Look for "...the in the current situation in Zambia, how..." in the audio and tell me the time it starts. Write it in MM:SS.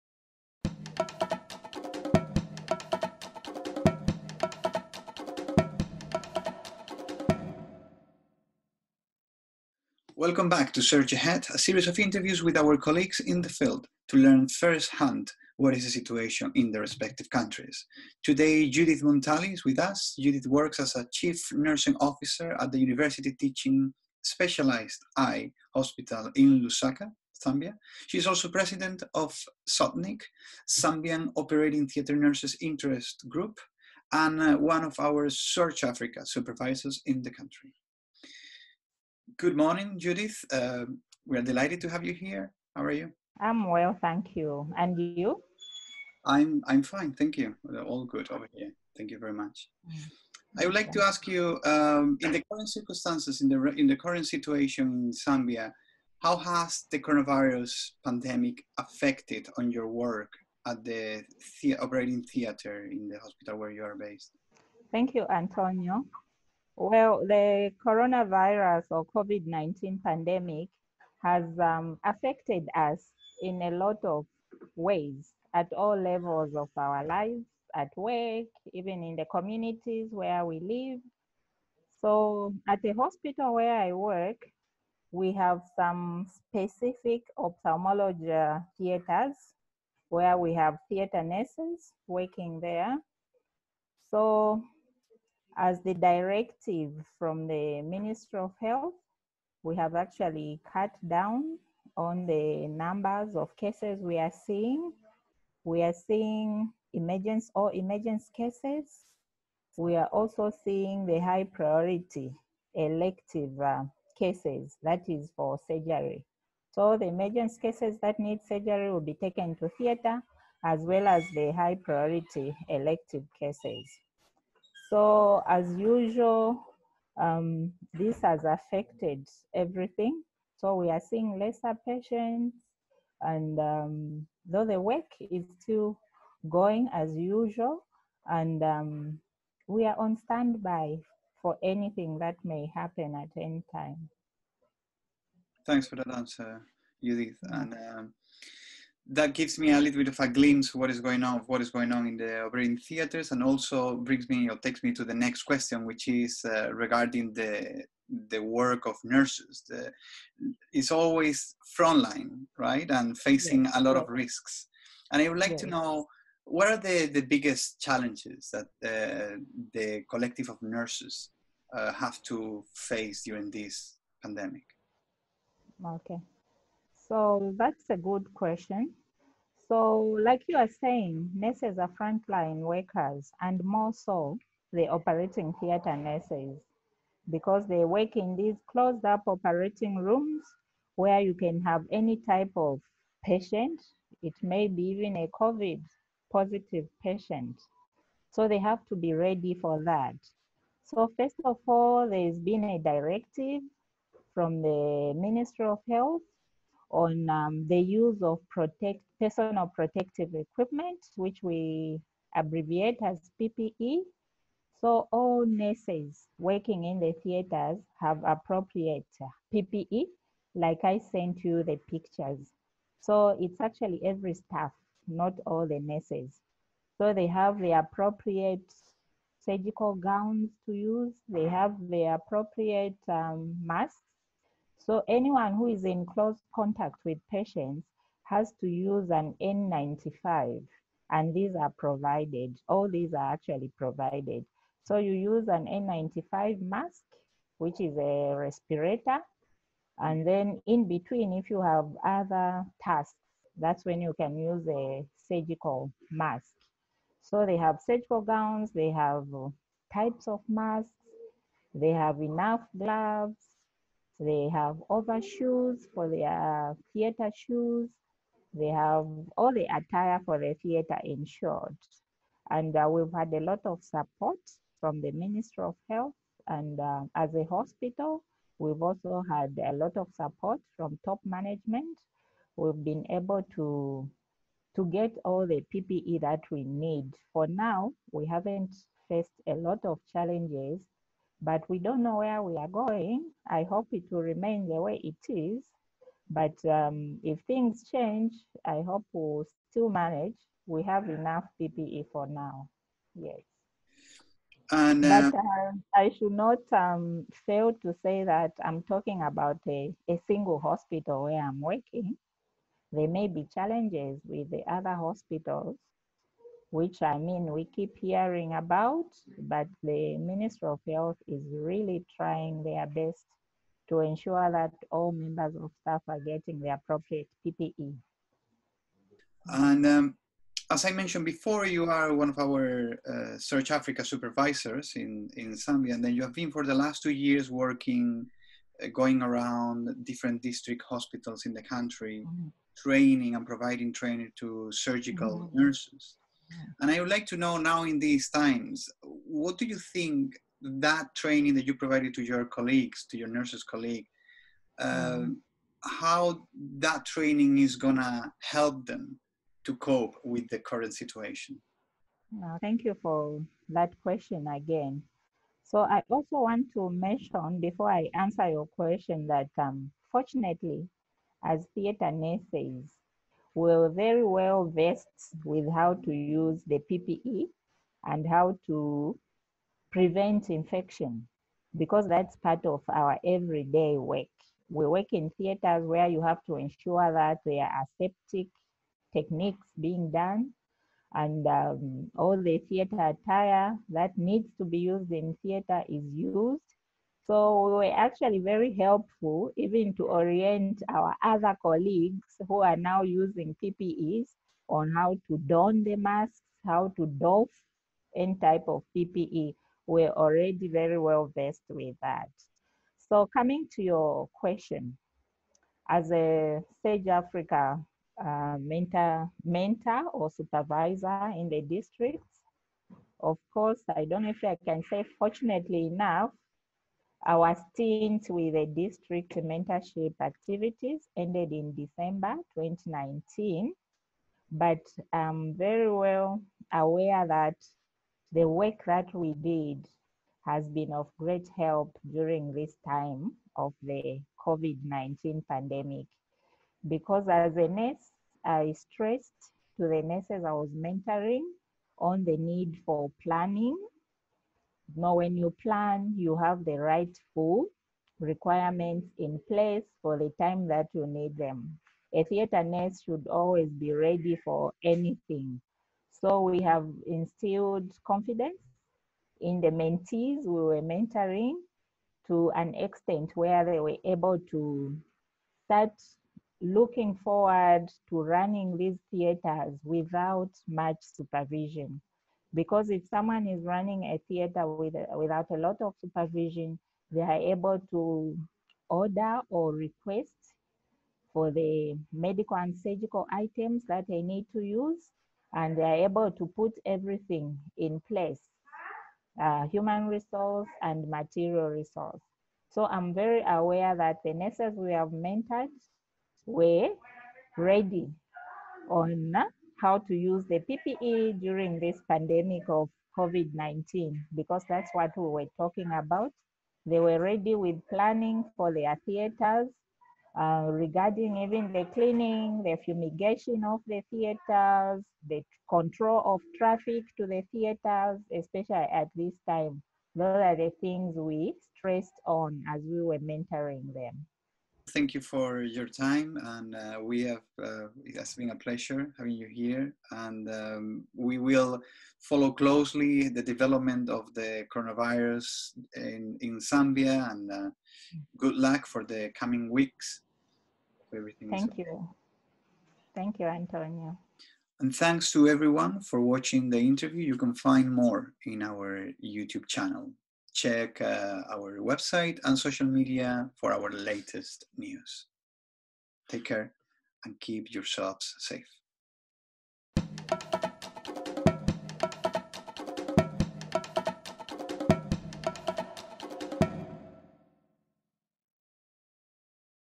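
00:53.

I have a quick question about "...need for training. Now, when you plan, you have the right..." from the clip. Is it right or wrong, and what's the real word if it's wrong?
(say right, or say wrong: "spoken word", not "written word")
wrong: "planning", not "training".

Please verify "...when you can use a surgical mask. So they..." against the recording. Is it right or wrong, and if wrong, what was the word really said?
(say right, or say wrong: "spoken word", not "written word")
right.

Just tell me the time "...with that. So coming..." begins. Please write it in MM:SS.
06:51.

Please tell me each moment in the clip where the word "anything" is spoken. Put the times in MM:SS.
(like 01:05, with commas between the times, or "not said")
02:21, 07:44.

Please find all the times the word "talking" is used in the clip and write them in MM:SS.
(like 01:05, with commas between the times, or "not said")
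05:08, 08:35.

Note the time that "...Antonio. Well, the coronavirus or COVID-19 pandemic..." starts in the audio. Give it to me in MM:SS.
01:05.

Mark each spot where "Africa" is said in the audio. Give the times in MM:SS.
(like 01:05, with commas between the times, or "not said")
00:35, 05:33, 06:56.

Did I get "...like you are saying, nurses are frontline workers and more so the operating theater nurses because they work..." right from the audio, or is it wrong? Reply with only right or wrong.
right.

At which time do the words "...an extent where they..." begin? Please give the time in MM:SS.
07:52.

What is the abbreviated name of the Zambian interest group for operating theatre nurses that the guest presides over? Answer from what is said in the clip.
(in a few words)
ZOTNIG.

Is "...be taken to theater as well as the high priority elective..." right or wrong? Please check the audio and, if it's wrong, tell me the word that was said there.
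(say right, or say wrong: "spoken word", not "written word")
right.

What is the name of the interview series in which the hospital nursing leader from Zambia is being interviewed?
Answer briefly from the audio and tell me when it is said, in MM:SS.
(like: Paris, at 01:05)
Surge Ahead, at 00:10.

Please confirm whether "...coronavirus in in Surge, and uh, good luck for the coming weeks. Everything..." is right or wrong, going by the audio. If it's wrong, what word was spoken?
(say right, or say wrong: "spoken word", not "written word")
wrong: "Zambia", not "Surge".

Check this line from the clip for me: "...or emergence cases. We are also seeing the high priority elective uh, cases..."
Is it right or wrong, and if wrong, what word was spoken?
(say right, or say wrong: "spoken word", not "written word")
right.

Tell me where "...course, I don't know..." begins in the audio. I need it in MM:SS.
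07:03.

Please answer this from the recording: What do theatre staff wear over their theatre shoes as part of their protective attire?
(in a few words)
overshoes.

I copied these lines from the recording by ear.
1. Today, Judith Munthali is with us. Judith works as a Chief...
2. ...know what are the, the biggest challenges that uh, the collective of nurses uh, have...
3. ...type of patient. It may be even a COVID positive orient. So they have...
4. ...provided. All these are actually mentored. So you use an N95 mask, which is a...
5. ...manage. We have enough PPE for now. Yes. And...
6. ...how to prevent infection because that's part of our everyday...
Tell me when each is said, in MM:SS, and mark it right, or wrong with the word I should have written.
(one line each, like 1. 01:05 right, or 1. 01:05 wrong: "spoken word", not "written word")
1. 00:18 right
2. 02:45 right
3. 03:12 wrong: "patient", not "orient"
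4. 04:01 wrong: "provided", not "mentored"
5. 04:59 right
6. 06:18 right.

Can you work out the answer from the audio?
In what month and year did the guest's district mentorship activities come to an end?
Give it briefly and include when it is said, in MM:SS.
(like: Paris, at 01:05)
December 2019, at 07:11.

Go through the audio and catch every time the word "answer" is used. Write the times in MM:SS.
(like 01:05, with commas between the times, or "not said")
02:26, 06:08.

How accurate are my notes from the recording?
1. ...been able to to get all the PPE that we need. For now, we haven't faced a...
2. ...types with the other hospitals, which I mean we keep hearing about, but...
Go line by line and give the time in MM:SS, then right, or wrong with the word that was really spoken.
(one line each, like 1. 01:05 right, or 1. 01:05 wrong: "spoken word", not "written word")
1. 04:42 right
2. 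05:13 wrong: "challenges", not "types".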